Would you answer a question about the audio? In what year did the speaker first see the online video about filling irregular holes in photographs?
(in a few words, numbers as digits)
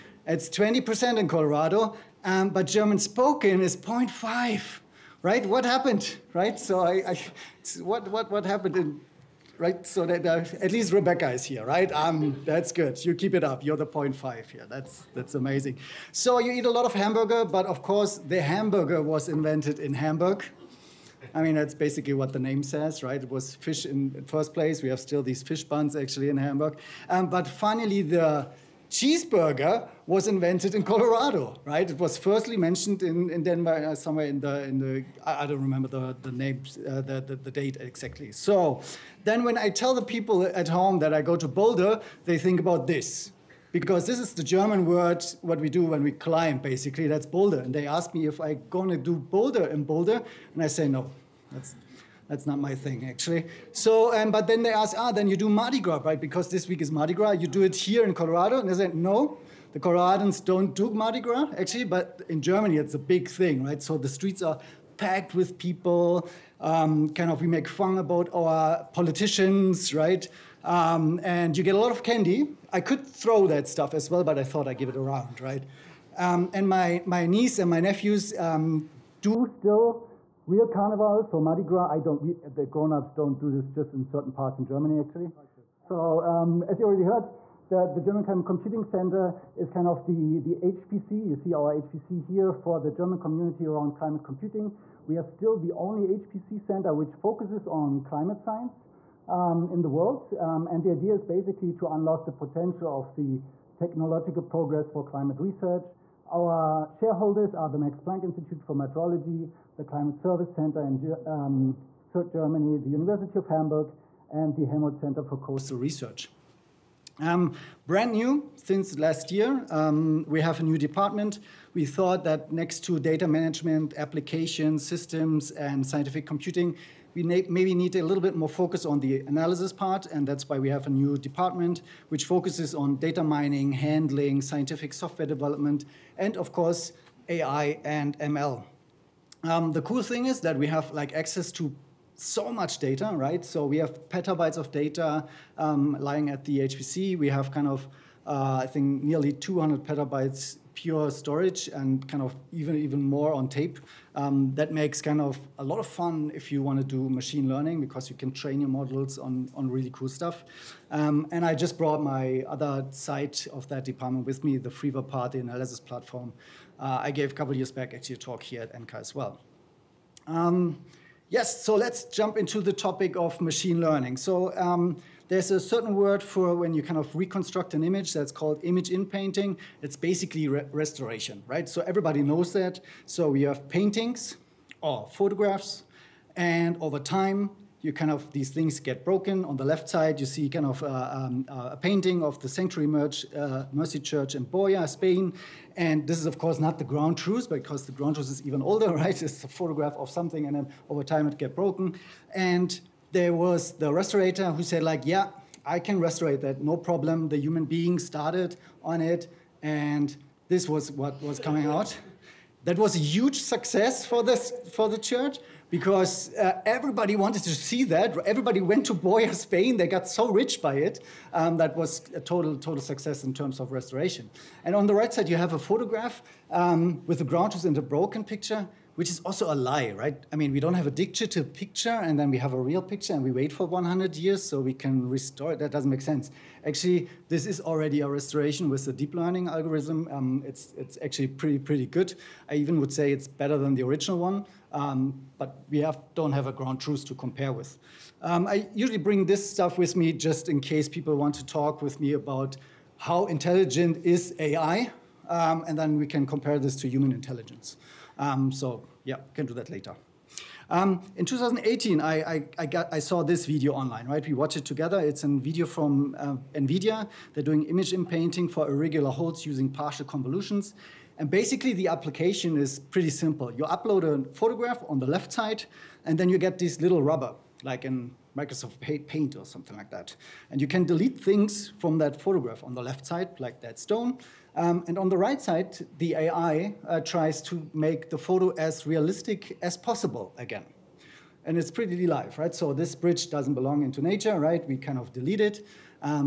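2018.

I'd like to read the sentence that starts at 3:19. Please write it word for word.
It's a photograph of something, and then over time it get broken.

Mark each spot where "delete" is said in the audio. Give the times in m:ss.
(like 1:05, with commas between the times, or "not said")
4:40, 4:55.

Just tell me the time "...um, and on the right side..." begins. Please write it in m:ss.
4:44.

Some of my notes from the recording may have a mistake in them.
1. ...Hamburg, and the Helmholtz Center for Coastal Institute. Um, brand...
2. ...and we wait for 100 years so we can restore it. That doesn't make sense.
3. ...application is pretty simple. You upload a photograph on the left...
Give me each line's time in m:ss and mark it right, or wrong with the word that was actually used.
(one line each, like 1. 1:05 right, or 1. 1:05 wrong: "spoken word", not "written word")
1. 1:53 wrong: "Research", not "Institute"
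2. 3:53 right
3. 4:31 right.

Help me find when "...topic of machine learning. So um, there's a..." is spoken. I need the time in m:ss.
2:52.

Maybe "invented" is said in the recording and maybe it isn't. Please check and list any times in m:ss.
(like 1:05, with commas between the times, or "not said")
0:19, 0:30.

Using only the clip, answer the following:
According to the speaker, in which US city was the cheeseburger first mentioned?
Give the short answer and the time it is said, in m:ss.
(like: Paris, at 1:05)
Denver, at 0:33.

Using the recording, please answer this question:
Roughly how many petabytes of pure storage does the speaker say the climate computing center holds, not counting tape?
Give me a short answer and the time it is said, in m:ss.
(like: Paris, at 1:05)
200 petabytes, at 2:29.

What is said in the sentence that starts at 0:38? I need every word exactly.
So then when I tell the people at home that I go to Boulder, they think about this.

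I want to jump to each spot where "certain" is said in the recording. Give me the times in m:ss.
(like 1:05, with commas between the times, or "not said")
1:24, 2:55.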